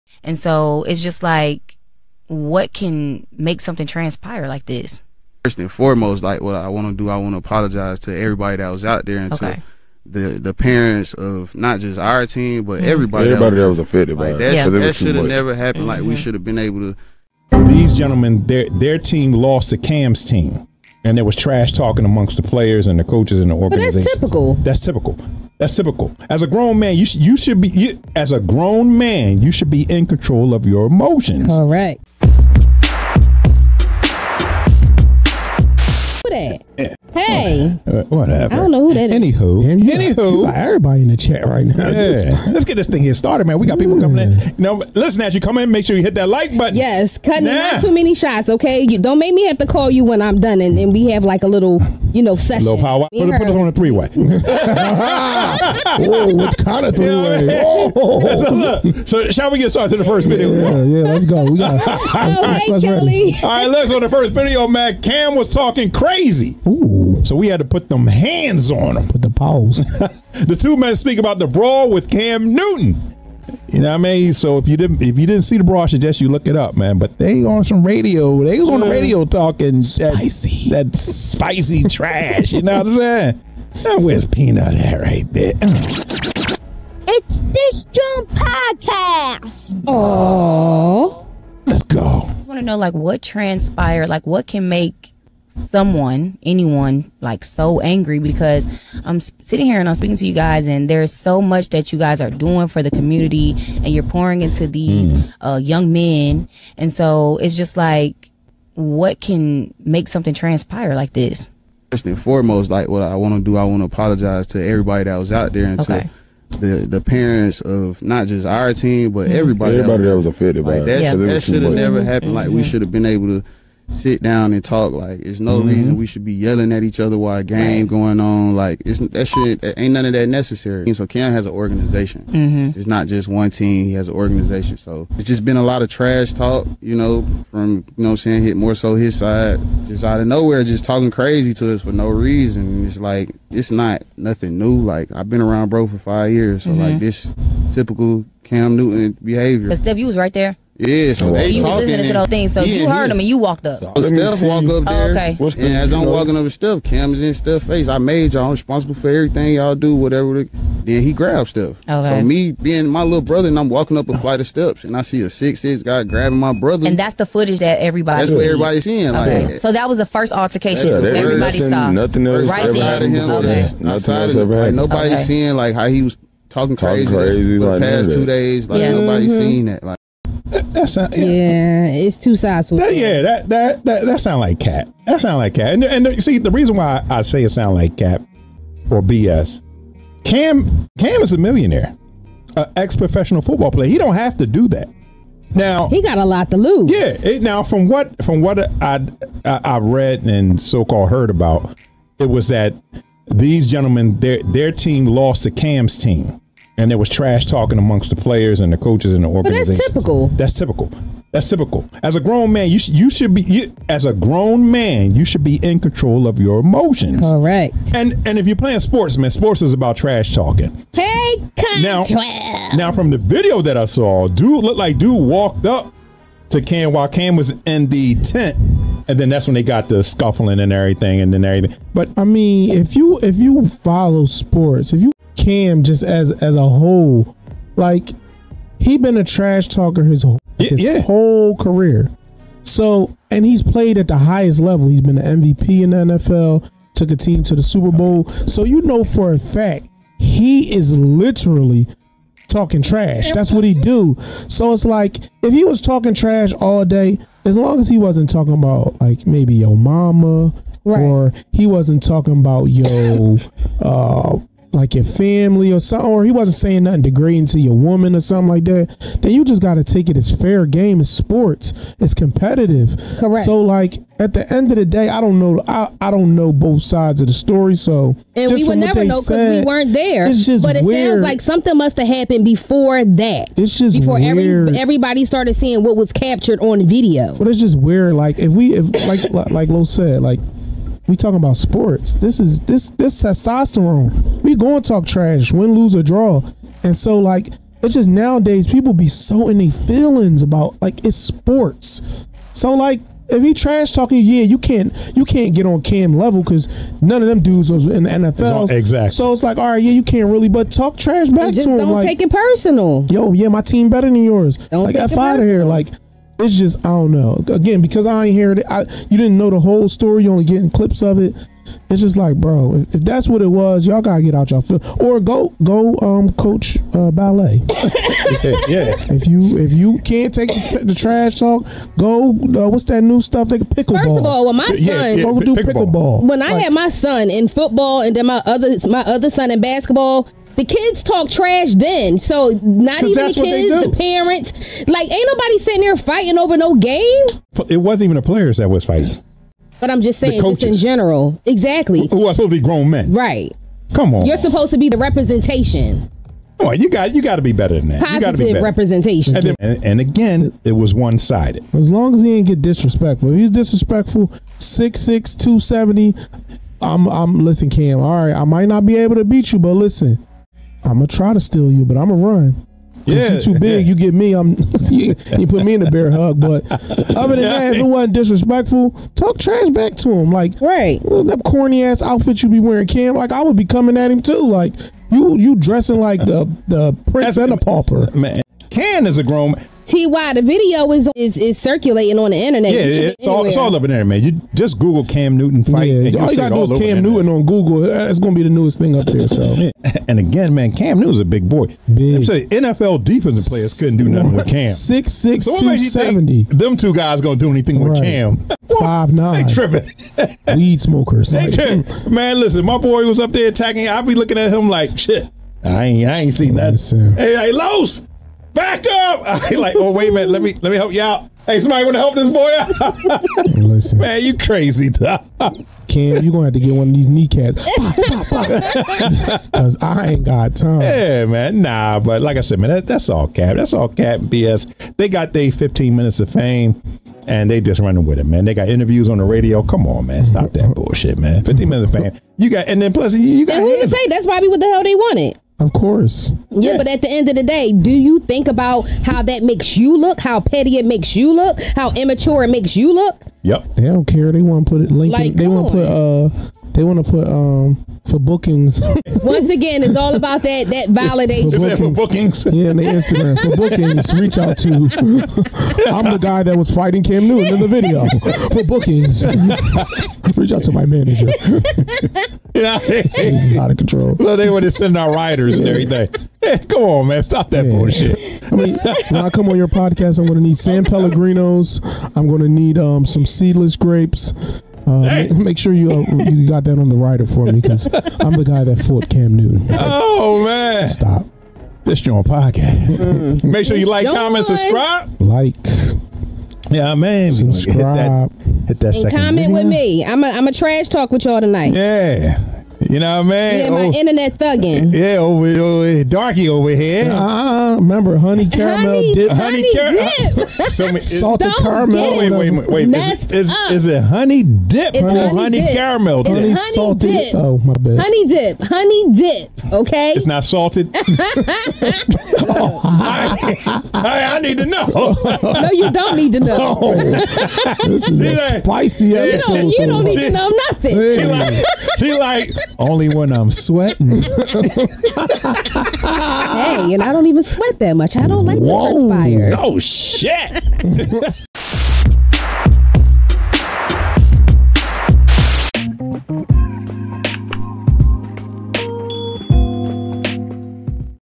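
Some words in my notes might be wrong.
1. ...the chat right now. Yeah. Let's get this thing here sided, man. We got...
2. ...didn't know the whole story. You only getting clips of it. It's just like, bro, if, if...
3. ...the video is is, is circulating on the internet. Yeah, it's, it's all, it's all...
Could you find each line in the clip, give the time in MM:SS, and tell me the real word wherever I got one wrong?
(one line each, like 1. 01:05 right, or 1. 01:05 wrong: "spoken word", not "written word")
1. 00:41 wrong: "started", not "sided"
2. 05:19 right
3. 06:30 right.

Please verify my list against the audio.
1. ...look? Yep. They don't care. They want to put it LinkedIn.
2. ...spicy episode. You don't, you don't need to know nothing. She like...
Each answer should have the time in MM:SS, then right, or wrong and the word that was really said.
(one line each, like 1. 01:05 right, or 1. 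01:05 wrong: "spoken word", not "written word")
1. 07:32 right
2. 08:48 right.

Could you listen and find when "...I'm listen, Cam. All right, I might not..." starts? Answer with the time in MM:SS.
06:07.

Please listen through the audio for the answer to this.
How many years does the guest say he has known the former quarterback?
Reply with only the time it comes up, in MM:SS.
02:25.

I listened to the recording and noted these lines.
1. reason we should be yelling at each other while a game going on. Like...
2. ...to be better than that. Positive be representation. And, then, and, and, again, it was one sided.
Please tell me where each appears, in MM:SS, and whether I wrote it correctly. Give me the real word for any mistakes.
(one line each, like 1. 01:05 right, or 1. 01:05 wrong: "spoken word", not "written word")
1. 02:05 right
2. 05:57 right.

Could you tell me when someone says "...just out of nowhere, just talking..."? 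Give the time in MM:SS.
02:19.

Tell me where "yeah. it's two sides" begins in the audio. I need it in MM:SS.
03:01.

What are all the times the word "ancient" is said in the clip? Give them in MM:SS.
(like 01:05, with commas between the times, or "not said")
not said.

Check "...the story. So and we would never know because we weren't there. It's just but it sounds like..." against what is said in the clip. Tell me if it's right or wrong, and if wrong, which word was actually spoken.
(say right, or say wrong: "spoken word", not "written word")
right.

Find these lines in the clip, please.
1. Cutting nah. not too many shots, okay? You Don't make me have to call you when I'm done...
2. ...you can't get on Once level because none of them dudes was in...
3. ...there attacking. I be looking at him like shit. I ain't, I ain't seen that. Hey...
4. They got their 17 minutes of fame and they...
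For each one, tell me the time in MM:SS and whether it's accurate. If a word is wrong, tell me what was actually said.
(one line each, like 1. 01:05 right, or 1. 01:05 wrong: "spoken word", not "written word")
1. 00:47 right
2. 05:05 wrong: "Cam", not "Once"
3. 06:53 right
4. 07:14 wrong: "15", not "17".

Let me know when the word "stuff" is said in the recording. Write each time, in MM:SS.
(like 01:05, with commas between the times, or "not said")
05:33.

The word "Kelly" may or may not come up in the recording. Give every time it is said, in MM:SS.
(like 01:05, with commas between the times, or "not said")
01:02.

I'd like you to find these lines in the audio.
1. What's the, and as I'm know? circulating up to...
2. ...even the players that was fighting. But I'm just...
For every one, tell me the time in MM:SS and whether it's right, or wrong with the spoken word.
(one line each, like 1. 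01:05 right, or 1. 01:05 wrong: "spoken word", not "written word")
1. 02:35 wrong: "walking", not "circulating"
2. 05:48 right.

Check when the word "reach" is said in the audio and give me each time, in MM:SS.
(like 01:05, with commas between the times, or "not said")
07:44, 07:50.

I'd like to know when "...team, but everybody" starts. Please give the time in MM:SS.
01:58.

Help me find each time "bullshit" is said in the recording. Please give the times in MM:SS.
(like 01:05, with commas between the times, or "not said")
07:20, 07:57.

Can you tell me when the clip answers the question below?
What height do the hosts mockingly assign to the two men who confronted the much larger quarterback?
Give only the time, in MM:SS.
06:48.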